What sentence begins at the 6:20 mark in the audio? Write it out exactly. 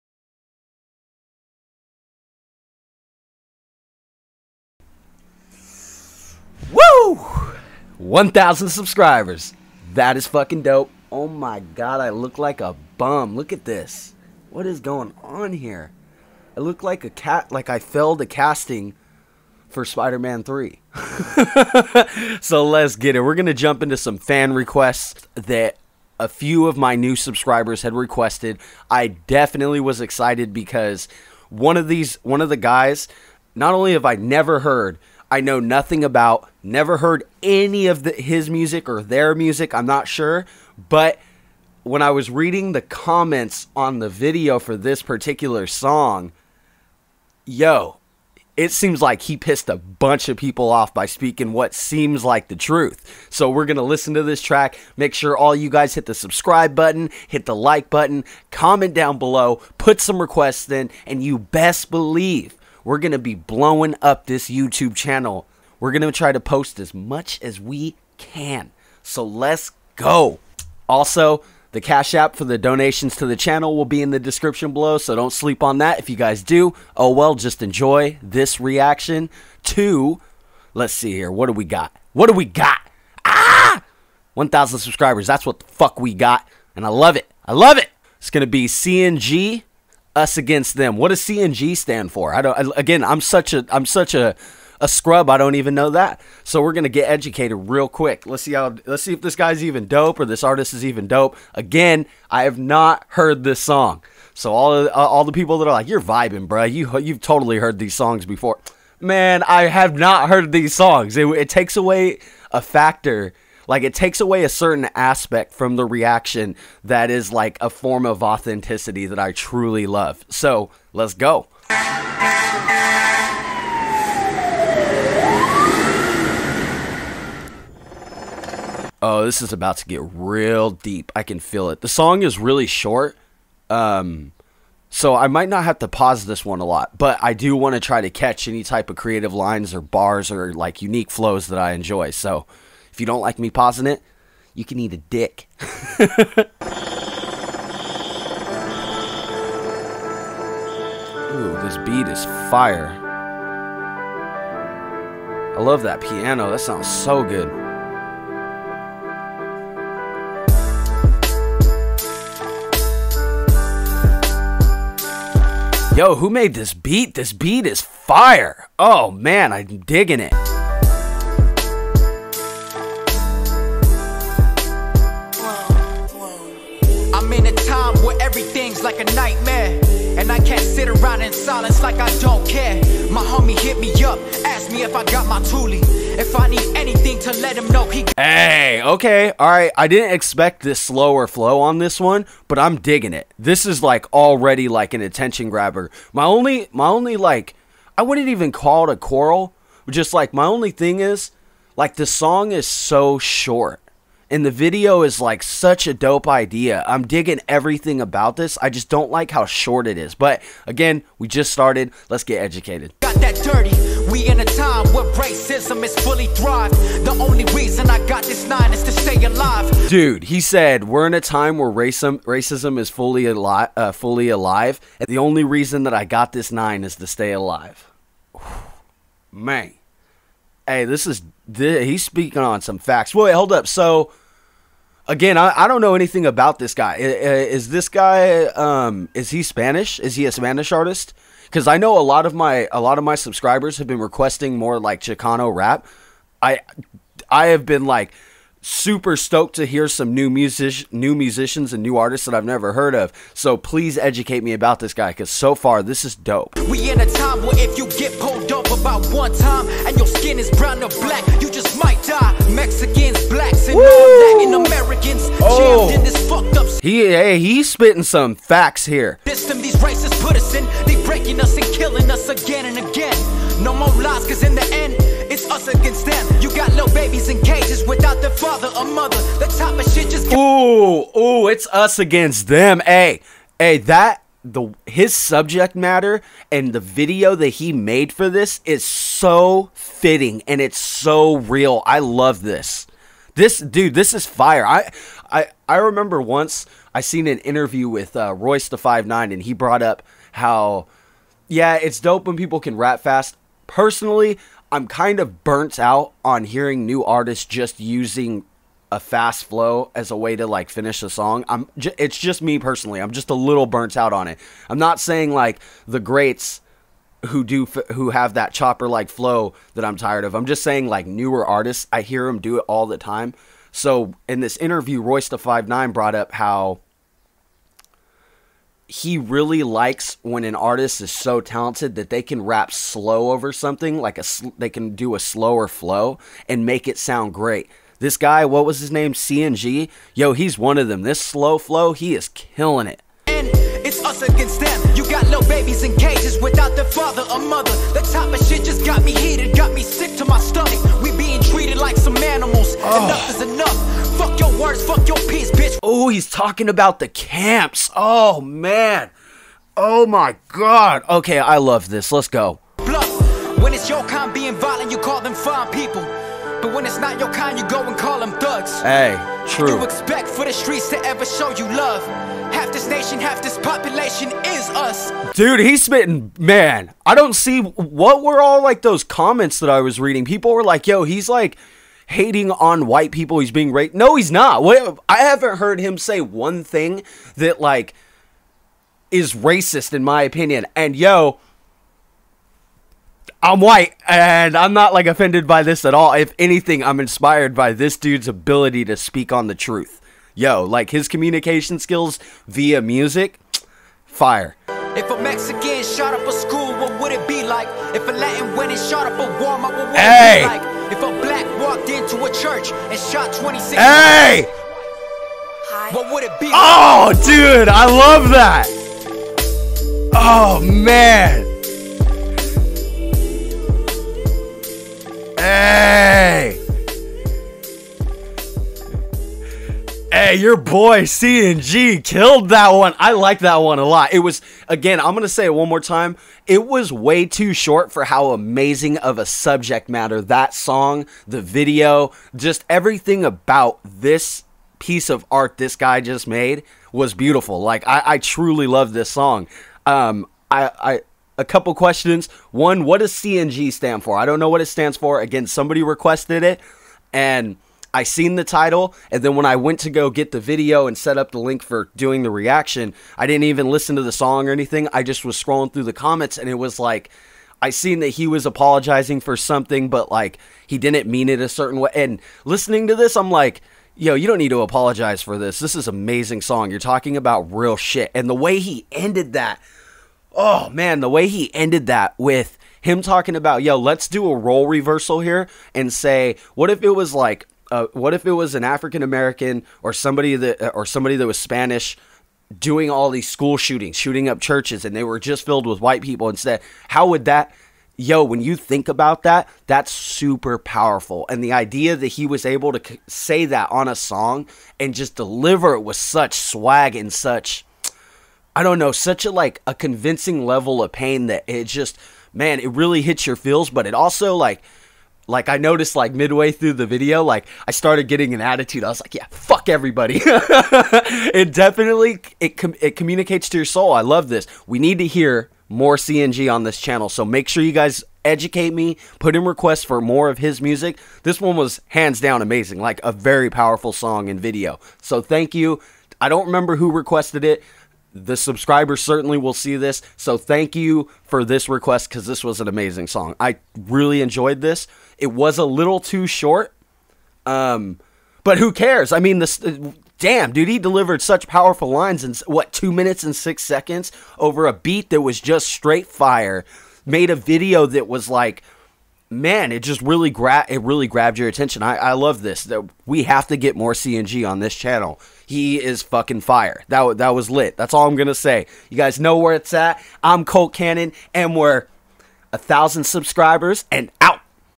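People were like, yo, he's like hating on white people.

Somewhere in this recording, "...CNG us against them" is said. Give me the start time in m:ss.
1:28.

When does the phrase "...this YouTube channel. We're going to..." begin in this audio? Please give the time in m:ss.
1:04.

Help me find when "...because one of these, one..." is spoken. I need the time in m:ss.
0:30.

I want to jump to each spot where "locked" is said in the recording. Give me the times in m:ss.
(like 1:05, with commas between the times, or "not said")
not said.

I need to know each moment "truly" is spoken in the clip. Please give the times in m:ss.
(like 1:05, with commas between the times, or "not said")
1:59, 7:28.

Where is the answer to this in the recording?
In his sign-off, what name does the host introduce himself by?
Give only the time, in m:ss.
9:30.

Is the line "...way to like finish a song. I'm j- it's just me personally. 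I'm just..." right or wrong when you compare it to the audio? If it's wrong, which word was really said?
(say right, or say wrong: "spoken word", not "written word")
right.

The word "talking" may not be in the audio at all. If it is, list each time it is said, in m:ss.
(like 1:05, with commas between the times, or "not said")
5:56, 7:56, 8:03.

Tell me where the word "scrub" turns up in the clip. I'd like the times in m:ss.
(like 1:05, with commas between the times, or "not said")
1:34.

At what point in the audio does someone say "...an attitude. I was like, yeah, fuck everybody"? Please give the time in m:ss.
8:38.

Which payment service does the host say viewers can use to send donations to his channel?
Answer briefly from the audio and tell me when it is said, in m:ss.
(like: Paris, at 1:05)
Cash App, at 1:11.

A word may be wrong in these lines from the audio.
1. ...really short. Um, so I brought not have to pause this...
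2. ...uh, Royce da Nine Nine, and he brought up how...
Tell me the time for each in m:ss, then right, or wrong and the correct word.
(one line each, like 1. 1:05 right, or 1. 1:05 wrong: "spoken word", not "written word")
1. 2:12 wrong: "might", not "brought"
2. 4:58 wrong: "Five", not "Nine".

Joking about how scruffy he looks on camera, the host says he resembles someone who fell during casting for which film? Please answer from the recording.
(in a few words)
Spider Man 3.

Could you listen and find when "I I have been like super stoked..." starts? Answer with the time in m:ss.
4:06.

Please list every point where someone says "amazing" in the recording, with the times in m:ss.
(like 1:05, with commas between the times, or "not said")
7:18, 7:55, 8:52, 9:02.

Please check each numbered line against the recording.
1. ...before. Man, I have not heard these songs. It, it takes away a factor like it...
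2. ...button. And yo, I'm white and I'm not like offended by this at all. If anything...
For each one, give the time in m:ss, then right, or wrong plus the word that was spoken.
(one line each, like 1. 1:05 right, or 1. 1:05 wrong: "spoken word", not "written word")
1. 1:48 right
2. 6:30 wrong: "opinion", not "button".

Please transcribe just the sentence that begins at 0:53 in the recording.
So we're going to listen to this track.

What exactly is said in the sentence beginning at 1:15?
If you guys do, oh well, just enjoy this reaction to, let's see here, what do we got?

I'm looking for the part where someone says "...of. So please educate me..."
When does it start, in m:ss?
4:12.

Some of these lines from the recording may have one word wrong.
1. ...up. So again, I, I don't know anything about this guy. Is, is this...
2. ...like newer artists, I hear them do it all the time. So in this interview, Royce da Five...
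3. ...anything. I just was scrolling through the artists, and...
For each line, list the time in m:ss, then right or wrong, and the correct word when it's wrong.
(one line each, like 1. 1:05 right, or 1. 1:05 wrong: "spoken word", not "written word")
1. 3:53 right
2. 5:20 right
3. 7:44 wrong: "comments", not "artists".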